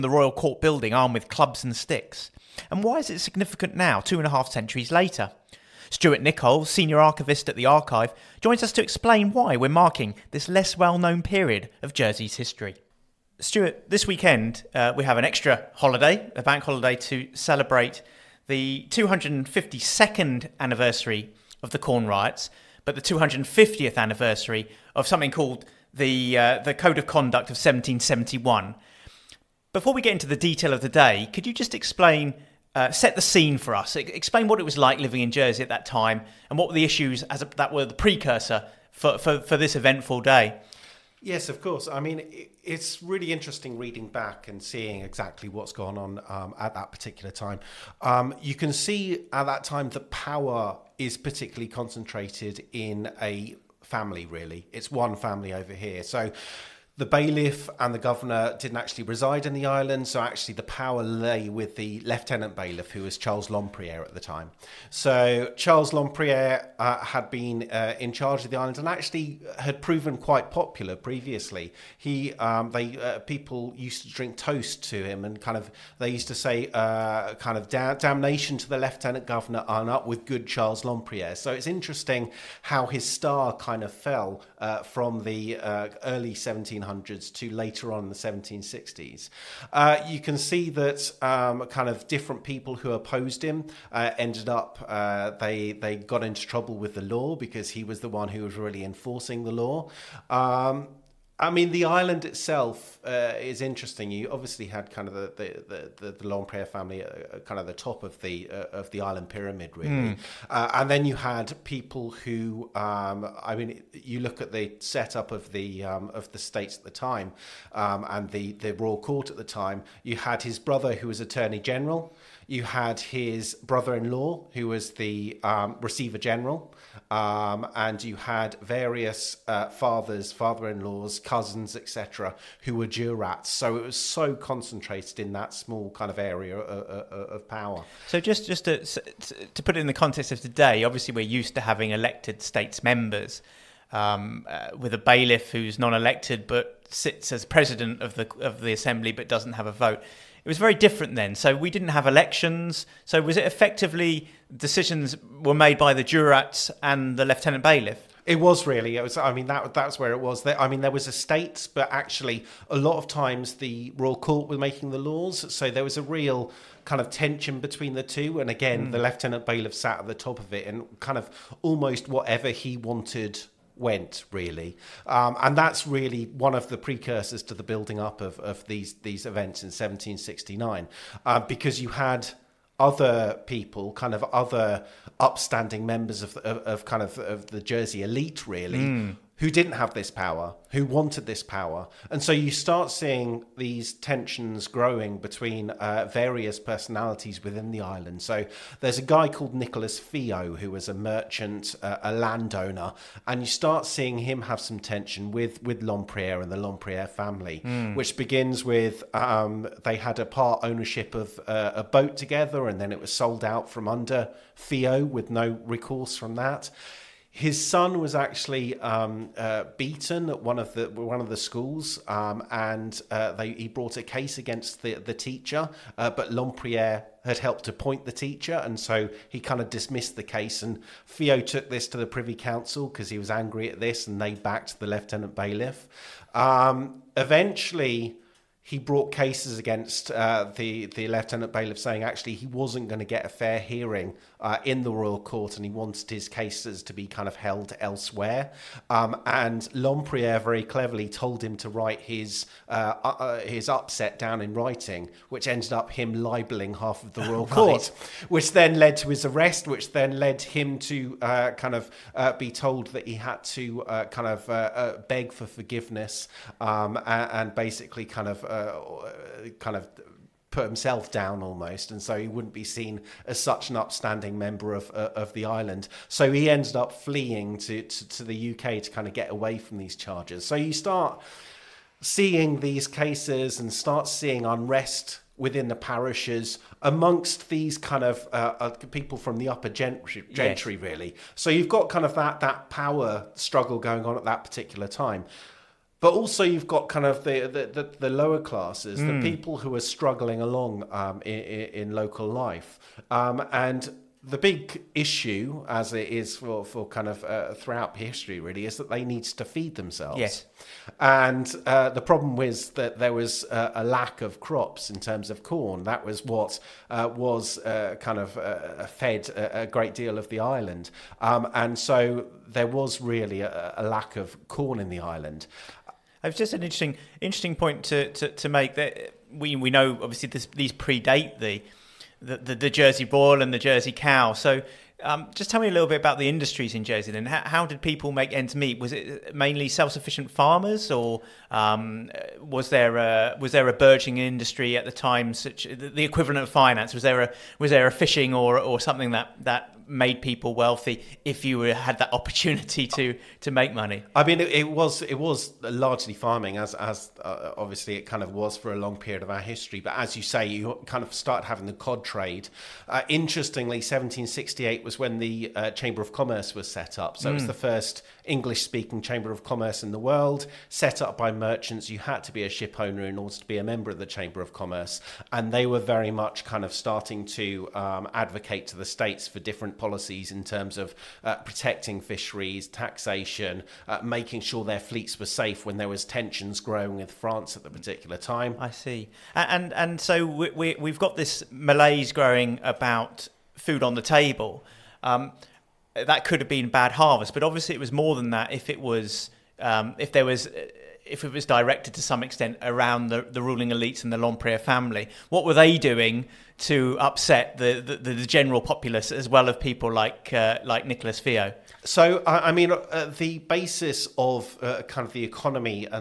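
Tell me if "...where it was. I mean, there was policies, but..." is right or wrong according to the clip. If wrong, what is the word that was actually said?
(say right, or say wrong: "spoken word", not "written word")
wrong: "estates", not "policies".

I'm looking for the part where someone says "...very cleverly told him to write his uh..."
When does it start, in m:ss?
4:10.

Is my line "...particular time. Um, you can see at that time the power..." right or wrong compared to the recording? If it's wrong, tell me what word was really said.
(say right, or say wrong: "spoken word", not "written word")
right.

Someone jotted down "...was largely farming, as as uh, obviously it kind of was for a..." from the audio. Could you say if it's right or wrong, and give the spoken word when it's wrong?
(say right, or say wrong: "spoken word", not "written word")
right.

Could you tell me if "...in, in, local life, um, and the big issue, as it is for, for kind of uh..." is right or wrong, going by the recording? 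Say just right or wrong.
right.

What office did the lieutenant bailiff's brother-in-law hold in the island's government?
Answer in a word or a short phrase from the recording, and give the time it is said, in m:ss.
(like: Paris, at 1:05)
Receiver General, at 2:05.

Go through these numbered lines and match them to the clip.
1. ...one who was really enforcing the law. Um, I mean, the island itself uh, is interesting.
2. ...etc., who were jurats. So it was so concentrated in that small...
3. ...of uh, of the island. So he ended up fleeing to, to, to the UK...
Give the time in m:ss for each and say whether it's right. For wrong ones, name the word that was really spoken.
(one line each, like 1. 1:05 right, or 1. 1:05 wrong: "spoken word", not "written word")
1. 1:38 right
2. 2:11 right
3. 4:34 right.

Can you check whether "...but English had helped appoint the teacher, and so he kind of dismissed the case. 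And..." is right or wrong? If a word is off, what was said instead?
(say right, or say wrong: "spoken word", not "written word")
wrong: "Lempriere", not "English".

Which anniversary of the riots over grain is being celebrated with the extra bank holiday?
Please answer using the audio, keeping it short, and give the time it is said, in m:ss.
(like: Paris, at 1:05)
252nd, at 0:18.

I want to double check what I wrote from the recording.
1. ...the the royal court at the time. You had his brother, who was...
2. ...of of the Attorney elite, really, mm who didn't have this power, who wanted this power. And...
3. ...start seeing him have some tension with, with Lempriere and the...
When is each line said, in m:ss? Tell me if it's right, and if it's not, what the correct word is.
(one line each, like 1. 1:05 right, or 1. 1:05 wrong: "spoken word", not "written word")
1. 1:58 right
2. 3:07 wrong: "Jersey", not "Attorney"
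3. 3:23 right.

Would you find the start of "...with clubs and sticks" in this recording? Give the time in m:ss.
0:01.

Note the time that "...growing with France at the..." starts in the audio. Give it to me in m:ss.
6:26.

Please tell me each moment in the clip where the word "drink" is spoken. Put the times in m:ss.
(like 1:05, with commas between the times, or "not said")
1:14.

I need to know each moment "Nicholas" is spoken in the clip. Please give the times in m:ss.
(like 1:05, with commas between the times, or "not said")
3:19, 6:50.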